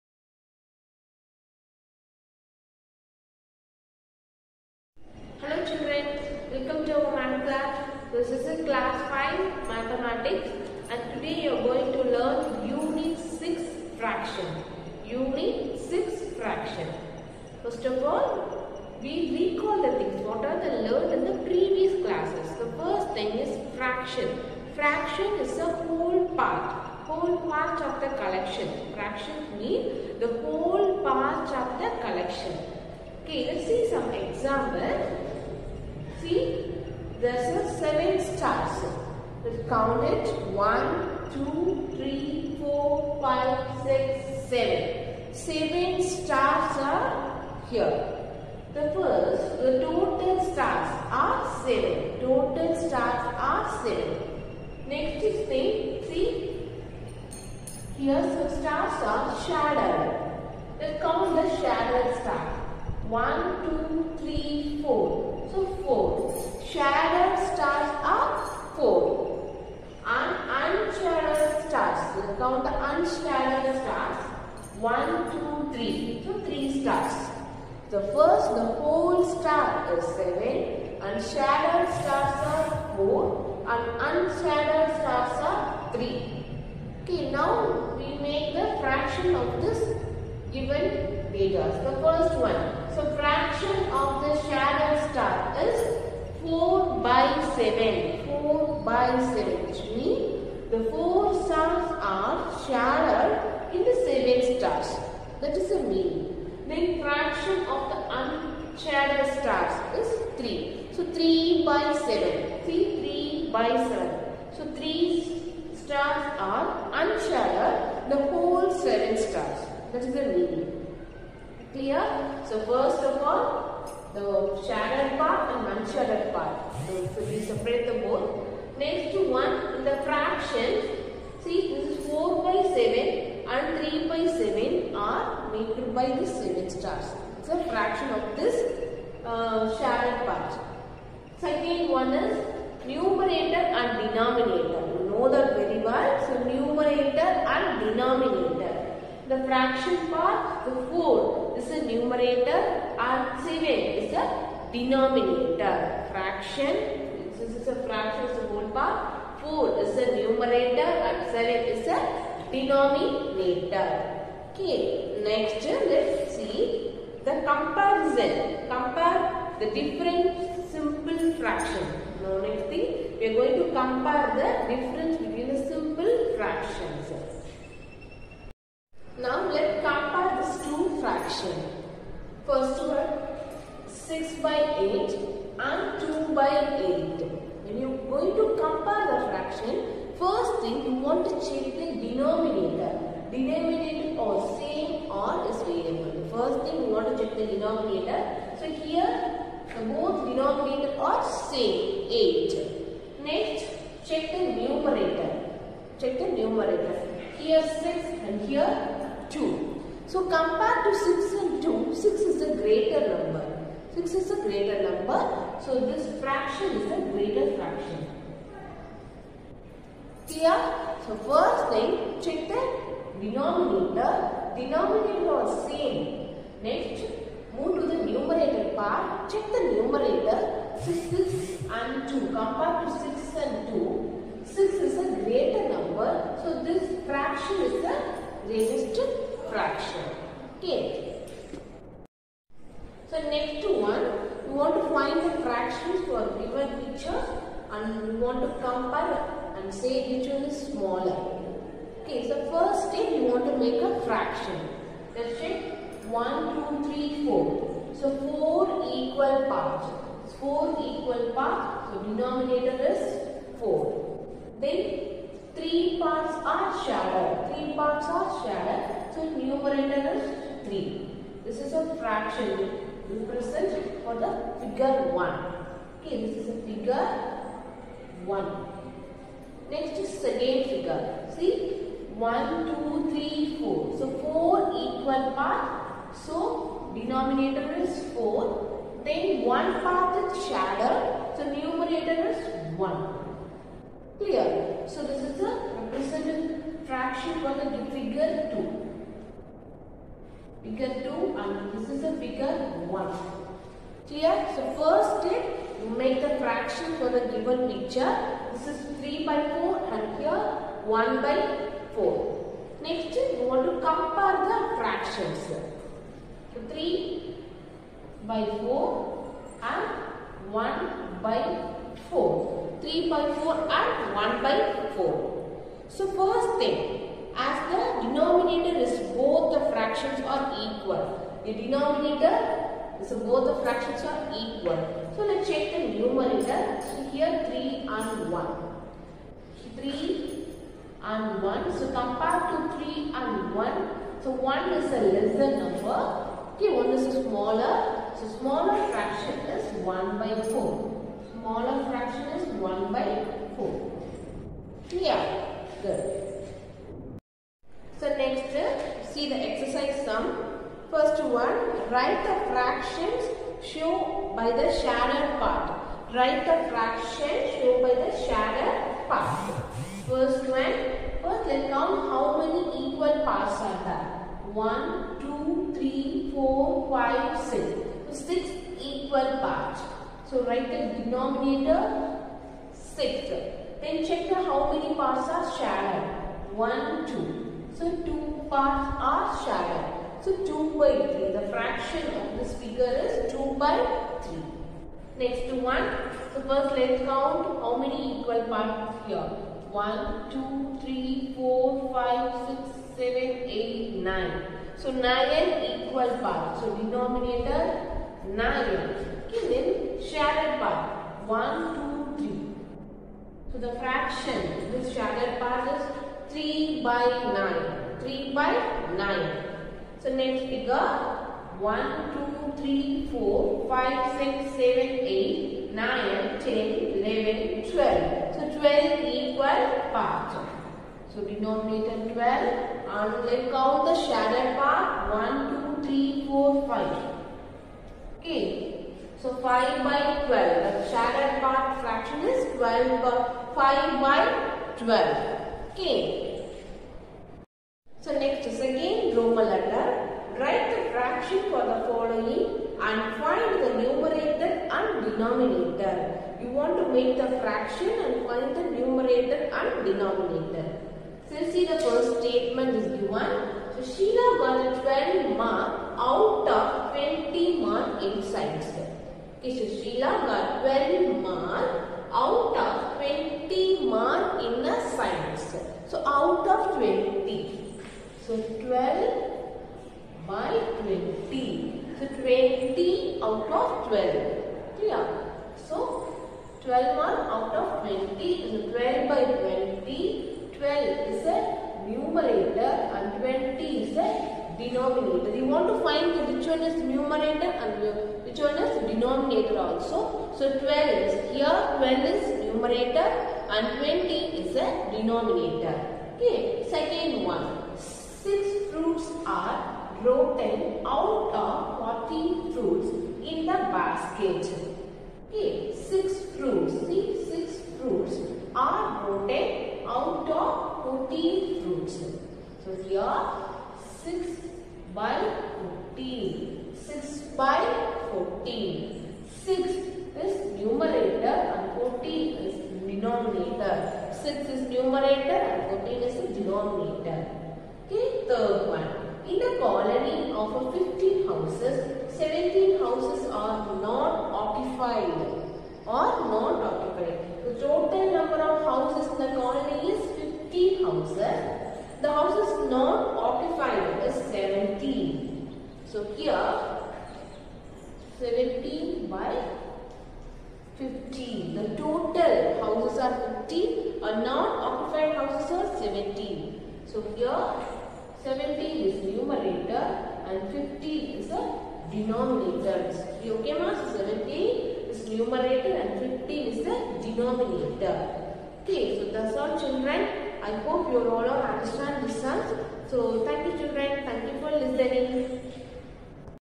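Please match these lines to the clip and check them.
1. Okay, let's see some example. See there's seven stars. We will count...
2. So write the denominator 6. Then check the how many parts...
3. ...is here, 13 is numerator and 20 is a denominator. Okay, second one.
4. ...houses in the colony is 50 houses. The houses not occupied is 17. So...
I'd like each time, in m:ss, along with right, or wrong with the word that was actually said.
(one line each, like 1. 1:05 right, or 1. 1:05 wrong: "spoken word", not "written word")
1. 0:33 right
2. 6:20 right
3. 8:21 wrong: "12", not "13"
4. 9:08 right.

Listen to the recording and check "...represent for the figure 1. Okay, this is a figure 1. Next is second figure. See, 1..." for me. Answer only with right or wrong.
right.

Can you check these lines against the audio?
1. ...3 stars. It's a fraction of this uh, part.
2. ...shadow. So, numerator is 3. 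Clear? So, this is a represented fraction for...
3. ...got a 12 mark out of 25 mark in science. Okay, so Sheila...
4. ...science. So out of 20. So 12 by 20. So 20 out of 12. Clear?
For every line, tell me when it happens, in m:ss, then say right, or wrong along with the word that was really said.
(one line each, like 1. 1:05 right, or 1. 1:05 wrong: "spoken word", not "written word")
1. 2:16 wrong: "7", not "3"
2. 4:50 wrong: "1", not "3"
3. 7:44 wrong: "20", not "25"
4. 7:54 right.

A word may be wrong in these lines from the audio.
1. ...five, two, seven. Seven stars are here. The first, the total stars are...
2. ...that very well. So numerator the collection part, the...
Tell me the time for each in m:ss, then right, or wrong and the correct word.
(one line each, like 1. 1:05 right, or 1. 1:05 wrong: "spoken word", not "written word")
1. 0:43 wrong: "six", not "two"
2. 2:25 wrong: "fraction", not "collection".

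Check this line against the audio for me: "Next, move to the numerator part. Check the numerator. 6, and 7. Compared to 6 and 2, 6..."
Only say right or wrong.
wrong.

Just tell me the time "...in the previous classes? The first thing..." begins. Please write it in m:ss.
0:21.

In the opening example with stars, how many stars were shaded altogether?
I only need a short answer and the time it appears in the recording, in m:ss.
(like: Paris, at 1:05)
4, at 1:05.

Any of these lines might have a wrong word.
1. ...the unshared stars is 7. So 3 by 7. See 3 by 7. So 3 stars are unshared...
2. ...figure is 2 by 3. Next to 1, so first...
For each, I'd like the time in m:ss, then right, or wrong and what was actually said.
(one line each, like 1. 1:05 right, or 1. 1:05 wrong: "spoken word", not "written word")
1. 1:47 wrong: "3", not "7"
2. 6:32 right.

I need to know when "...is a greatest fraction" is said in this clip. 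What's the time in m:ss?
3:57.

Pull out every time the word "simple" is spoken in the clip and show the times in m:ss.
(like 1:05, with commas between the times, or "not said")
2:50, 2:55.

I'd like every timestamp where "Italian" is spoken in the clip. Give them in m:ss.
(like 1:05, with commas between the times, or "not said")
not said.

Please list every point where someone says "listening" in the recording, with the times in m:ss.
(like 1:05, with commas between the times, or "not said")
9:44.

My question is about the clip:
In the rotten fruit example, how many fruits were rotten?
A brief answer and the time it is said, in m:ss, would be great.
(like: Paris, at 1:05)
6, at 8:37.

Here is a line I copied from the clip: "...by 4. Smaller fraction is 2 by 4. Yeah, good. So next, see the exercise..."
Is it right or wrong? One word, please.
wrong.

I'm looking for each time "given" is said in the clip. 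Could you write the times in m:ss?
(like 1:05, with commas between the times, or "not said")
1:30, 4:06, 5:07, 7:42.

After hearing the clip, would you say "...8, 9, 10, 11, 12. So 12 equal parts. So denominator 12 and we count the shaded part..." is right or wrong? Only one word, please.
right.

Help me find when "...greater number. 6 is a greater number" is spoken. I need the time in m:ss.
3:32.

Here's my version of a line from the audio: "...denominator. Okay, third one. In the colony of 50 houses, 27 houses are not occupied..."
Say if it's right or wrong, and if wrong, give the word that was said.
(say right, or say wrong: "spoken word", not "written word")
wrong: "17", not "27".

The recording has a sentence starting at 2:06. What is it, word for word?
So, so we separate the both.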